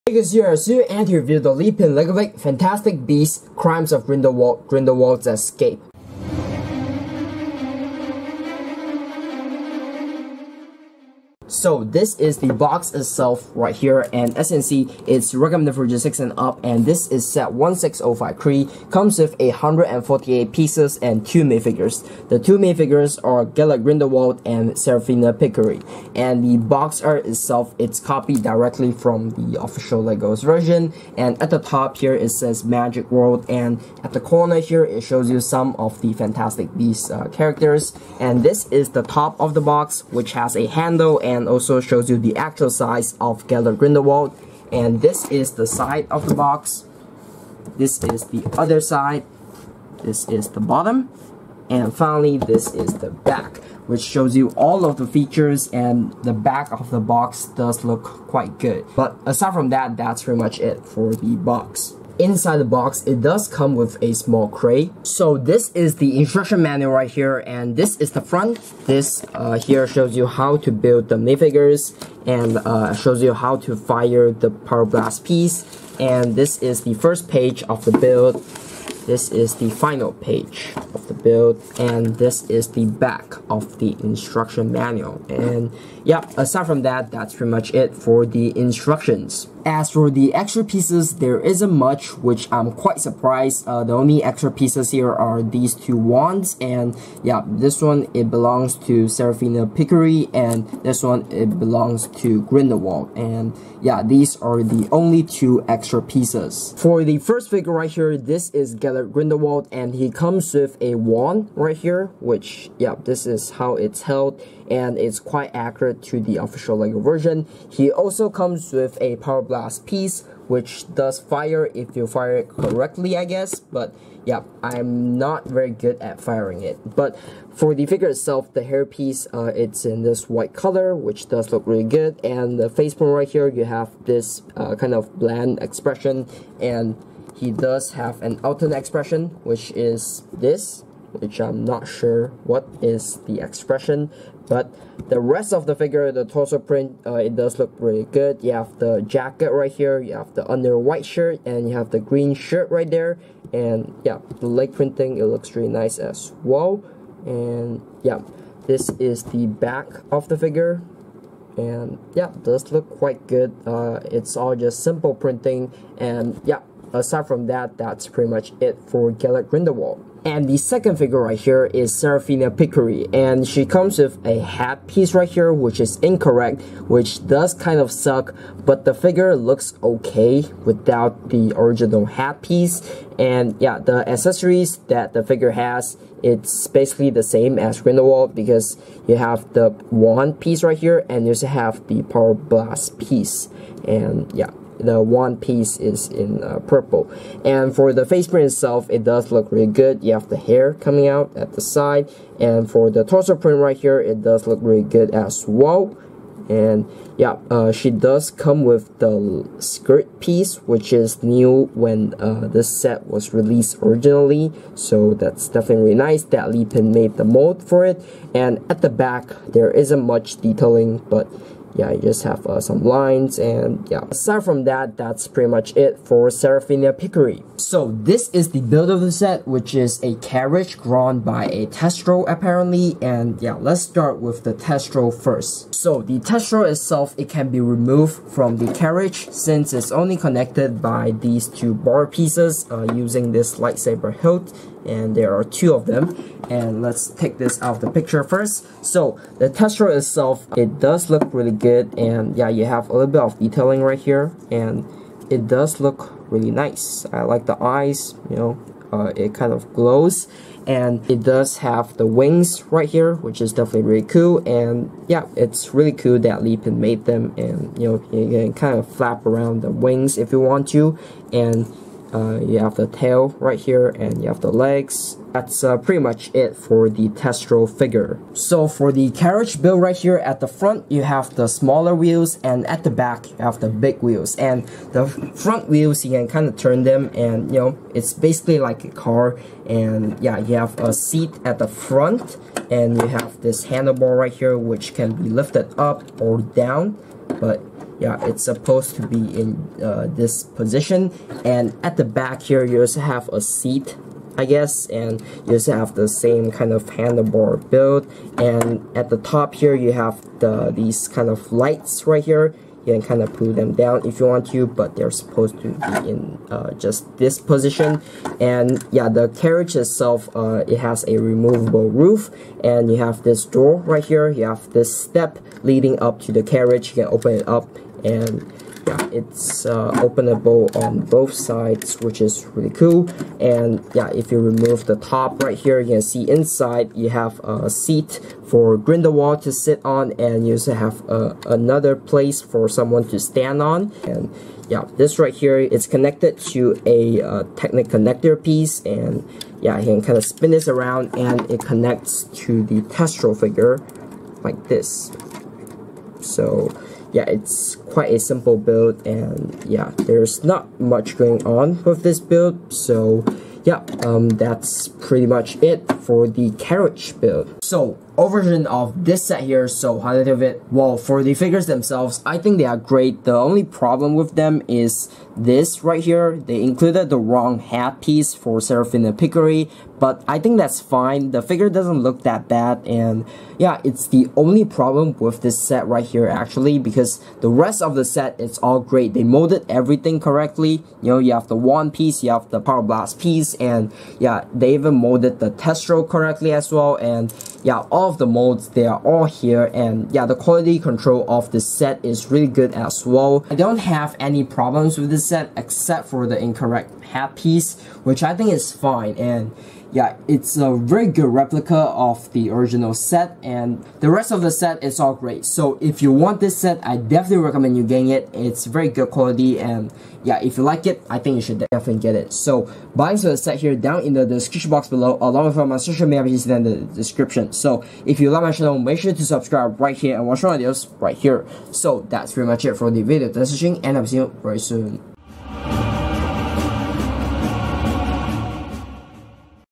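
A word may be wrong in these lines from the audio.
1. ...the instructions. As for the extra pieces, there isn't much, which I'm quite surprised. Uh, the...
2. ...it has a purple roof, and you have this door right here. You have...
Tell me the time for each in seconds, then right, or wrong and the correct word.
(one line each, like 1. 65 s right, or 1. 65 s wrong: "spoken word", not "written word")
1. 88 s right
2. 320 s wrong: "removable", not "purple".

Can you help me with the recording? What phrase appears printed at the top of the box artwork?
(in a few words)
Magic World.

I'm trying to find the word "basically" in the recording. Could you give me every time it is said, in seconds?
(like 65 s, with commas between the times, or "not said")
186 s, 288 s.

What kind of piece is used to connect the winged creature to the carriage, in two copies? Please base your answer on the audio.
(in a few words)
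Lightsaber hilt.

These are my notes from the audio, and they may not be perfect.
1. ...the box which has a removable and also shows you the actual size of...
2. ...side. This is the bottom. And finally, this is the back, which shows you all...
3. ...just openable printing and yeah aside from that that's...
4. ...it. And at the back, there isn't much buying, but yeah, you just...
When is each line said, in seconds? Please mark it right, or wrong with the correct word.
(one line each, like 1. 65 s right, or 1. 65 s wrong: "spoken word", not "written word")
1. 39 s wrong: "handle", not "removable"
2. 48 s right
3. 164 s wrong: "simple", not "openable"
4. 217 s wrong: "detailing", not "buying".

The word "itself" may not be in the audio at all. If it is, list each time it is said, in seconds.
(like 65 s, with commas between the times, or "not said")
12 s, 27 s, 128 s, 198 s, 236 s, 249 s, 319 s.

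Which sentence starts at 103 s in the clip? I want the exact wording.
And yeah, these are the only two extra pieces.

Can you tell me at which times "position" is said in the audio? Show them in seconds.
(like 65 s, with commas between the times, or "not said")
300 s, 317 s.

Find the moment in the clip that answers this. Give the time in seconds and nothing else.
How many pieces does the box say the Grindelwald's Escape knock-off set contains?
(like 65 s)
19 s.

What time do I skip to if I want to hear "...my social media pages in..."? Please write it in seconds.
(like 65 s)
425 s.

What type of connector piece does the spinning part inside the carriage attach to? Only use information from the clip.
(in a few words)
Technic connector.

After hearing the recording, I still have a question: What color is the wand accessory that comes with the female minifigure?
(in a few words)
Purple.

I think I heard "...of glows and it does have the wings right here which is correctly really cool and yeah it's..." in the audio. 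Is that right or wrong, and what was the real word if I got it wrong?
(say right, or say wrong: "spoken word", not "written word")
wrong: "definitely", not "correctly".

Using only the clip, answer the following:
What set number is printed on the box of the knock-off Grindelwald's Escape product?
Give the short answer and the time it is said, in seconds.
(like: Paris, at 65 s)
16053, at 17 s.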